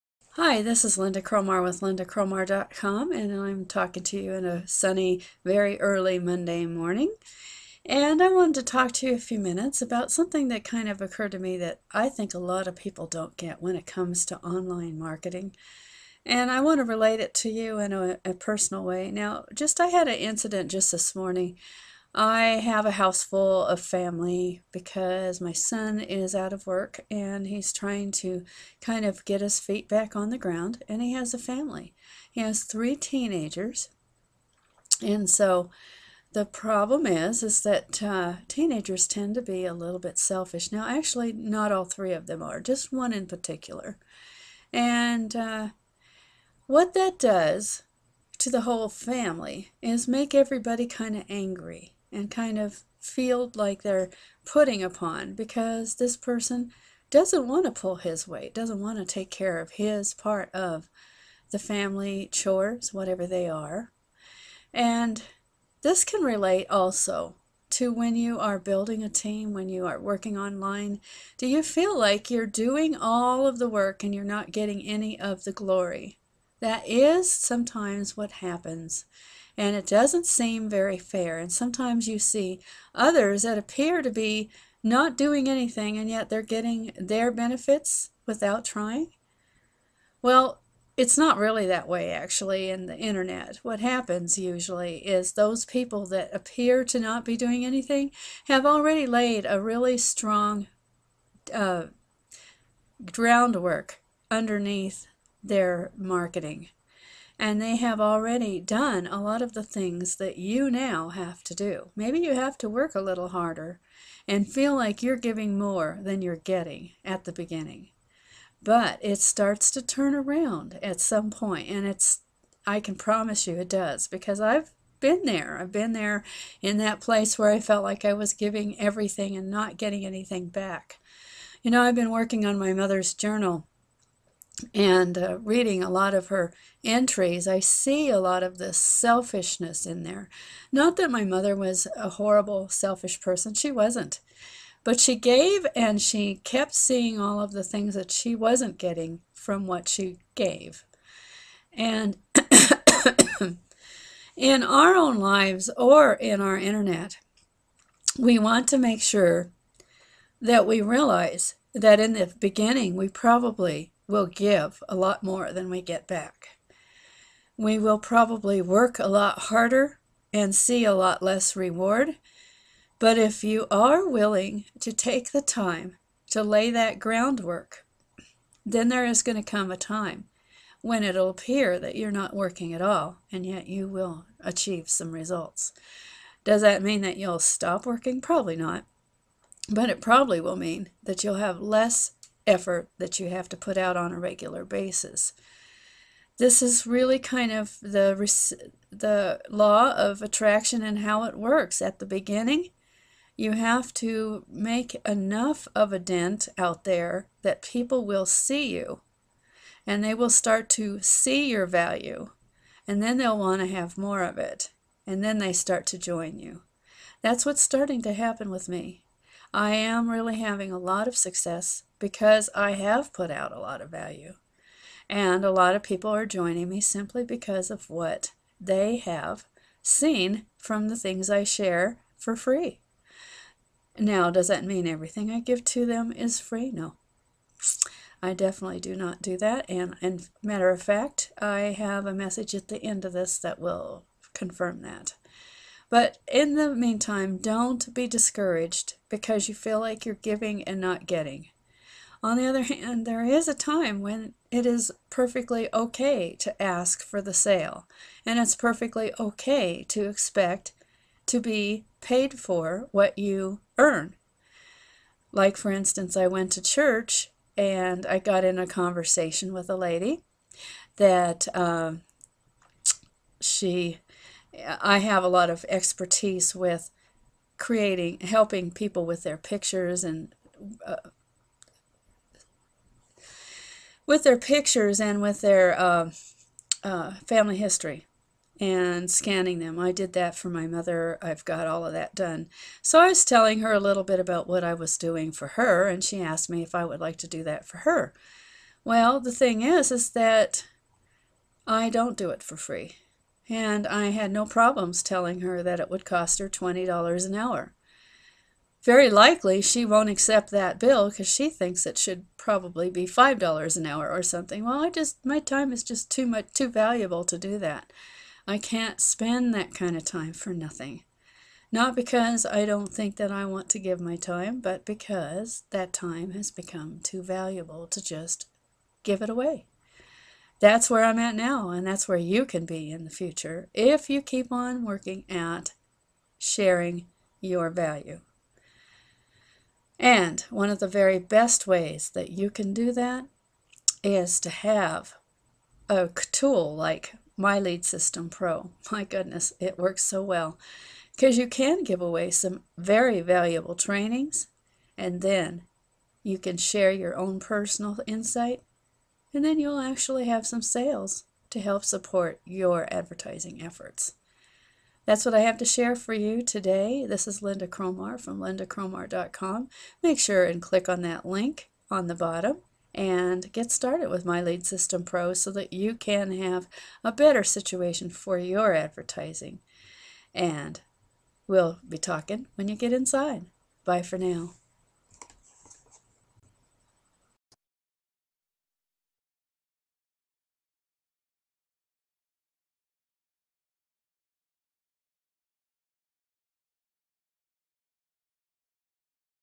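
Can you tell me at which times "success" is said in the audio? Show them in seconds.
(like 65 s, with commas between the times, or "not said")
221 s.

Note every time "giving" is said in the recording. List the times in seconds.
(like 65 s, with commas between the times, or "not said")
115 s, 128 s, 250 s.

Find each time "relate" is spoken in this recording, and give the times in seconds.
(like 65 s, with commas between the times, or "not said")
16 s, 66 s.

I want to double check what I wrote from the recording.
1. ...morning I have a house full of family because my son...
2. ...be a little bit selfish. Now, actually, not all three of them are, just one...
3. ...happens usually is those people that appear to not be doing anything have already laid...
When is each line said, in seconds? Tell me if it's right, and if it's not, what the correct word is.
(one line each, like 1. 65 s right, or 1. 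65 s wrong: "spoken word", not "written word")
1. 21 s right
2. 39 s right
3. 93 s right.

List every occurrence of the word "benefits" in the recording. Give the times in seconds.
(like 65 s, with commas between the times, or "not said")
87 s.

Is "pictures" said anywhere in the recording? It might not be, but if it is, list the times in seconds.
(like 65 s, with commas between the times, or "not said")
279 s, 284 s.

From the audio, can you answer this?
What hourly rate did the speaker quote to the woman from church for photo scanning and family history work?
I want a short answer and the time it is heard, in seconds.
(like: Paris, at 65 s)
$20 an hour, at 306 s.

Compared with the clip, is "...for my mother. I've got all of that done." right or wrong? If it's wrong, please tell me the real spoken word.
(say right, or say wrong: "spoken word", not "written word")
right.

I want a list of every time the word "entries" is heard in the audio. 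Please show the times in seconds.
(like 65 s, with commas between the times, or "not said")
136 s.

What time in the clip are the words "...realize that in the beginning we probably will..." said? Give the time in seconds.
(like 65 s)
160 s.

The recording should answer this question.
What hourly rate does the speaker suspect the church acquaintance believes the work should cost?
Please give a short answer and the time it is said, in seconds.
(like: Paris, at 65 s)
$5 an hour, at 313 s.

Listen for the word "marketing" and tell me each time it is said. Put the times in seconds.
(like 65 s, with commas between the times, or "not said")
14 s, 105 s.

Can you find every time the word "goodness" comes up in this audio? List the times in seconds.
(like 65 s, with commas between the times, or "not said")
349 s.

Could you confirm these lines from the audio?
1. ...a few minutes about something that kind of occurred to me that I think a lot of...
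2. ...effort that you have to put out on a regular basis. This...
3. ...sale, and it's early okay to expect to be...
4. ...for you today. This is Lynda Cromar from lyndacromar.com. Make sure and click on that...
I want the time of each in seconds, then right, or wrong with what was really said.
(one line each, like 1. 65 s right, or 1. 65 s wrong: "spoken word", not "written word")
1. 9 s right
2. 192 s right
3. 257 s wrong: "perfectly", not "early"
4. 365 s right.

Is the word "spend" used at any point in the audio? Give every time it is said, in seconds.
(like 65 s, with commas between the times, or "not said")
318 s.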